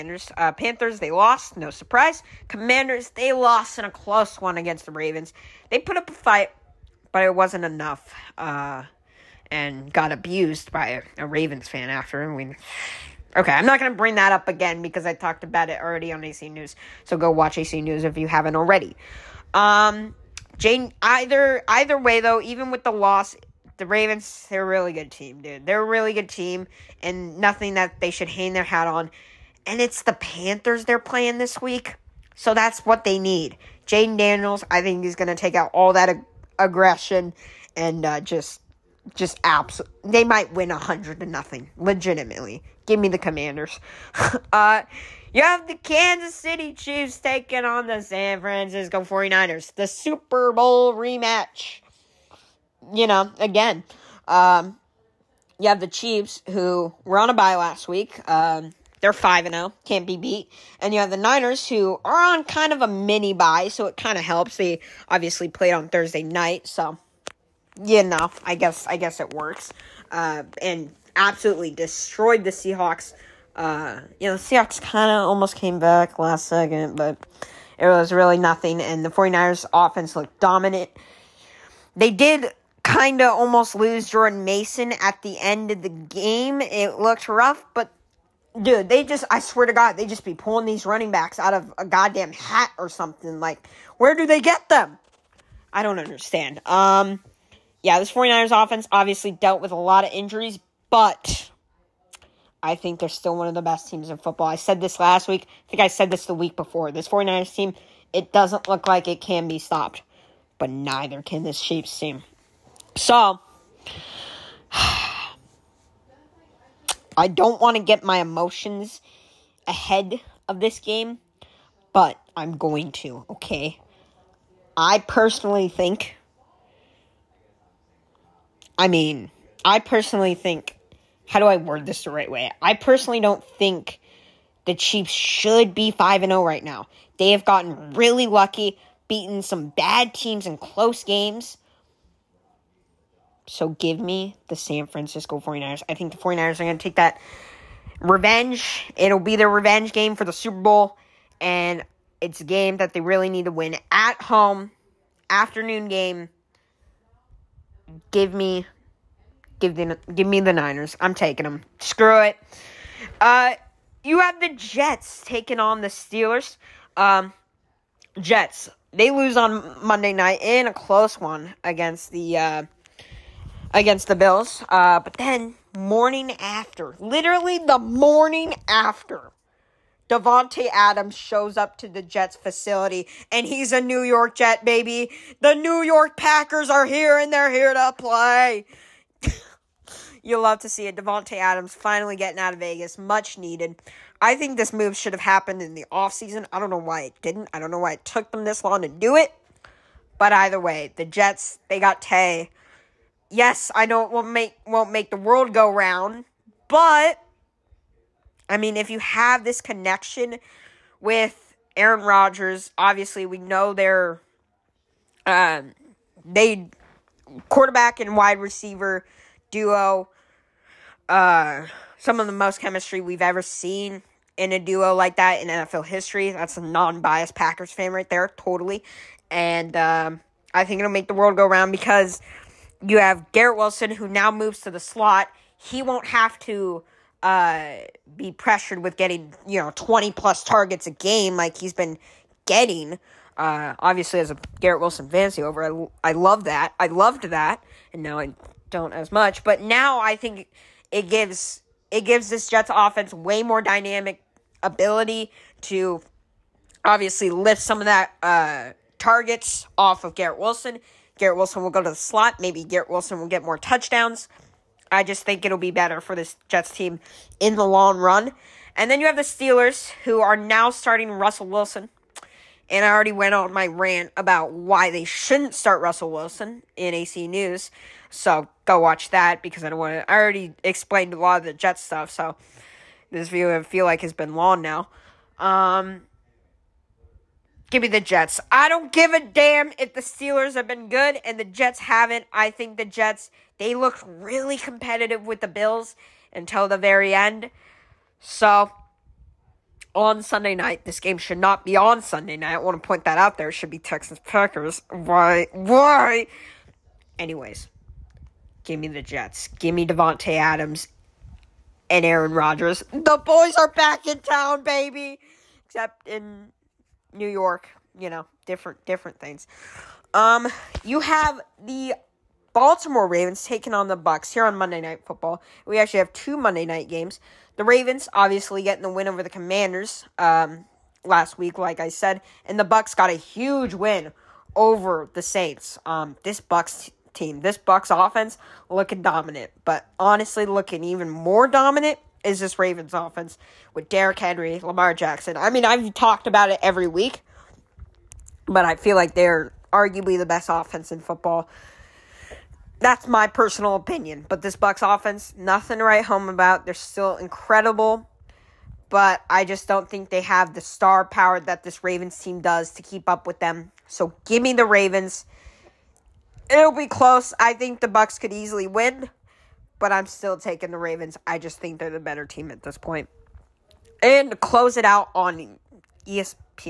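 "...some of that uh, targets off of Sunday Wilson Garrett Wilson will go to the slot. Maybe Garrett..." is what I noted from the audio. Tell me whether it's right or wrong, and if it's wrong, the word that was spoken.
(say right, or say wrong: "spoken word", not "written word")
wrong: "Garrett", not "Sunday".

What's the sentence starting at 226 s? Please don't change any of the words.
That's a non-biased Packers fan right there, totally.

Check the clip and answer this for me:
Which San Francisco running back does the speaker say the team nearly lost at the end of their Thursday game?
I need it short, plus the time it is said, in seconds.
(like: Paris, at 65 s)
Jordan Mason, at 84 s.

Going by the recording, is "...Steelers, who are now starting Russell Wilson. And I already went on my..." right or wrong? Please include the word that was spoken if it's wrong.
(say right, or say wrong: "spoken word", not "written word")
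right.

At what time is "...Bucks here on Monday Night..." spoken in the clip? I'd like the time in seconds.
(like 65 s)
323 s.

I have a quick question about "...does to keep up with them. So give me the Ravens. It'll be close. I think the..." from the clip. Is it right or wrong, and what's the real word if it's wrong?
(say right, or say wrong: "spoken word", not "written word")
right.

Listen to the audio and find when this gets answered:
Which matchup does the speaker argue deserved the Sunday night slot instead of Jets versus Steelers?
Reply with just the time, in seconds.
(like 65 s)
303 s.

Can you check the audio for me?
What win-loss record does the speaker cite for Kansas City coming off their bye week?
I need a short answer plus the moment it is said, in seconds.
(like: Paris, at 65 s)
5-0, at 59 s.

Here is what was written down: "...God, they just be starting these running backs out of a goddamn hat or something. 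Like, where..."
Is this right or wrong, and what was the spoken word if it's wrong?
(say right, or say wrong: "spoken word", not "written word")
wrong: "pulling", not "starting".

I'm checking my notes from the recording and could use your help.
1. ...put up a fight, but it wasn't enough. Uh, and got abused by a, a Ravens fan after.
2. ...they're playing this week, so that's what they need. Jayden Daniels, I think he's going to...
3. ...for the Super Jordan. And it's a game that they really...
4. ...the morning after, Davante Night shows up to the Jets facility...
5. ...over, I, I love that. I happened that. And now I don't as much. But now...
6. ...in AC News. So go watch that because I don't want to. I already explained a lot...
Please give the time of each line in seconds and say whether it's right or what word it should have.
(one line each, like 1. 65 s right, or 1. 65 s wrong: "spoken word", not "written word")
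1. 5 s right
2. 30 s right
3. 150 s wrong: "Bowl", not "Jordan"
4. 177 s wrong: "Adams", not "Night"
5. 245 s wrong: "loved", not "happened"
6. 276 s right.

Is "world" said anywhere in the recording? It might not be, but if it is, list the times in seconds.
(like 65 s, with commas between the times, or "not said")
205 s, 231 s.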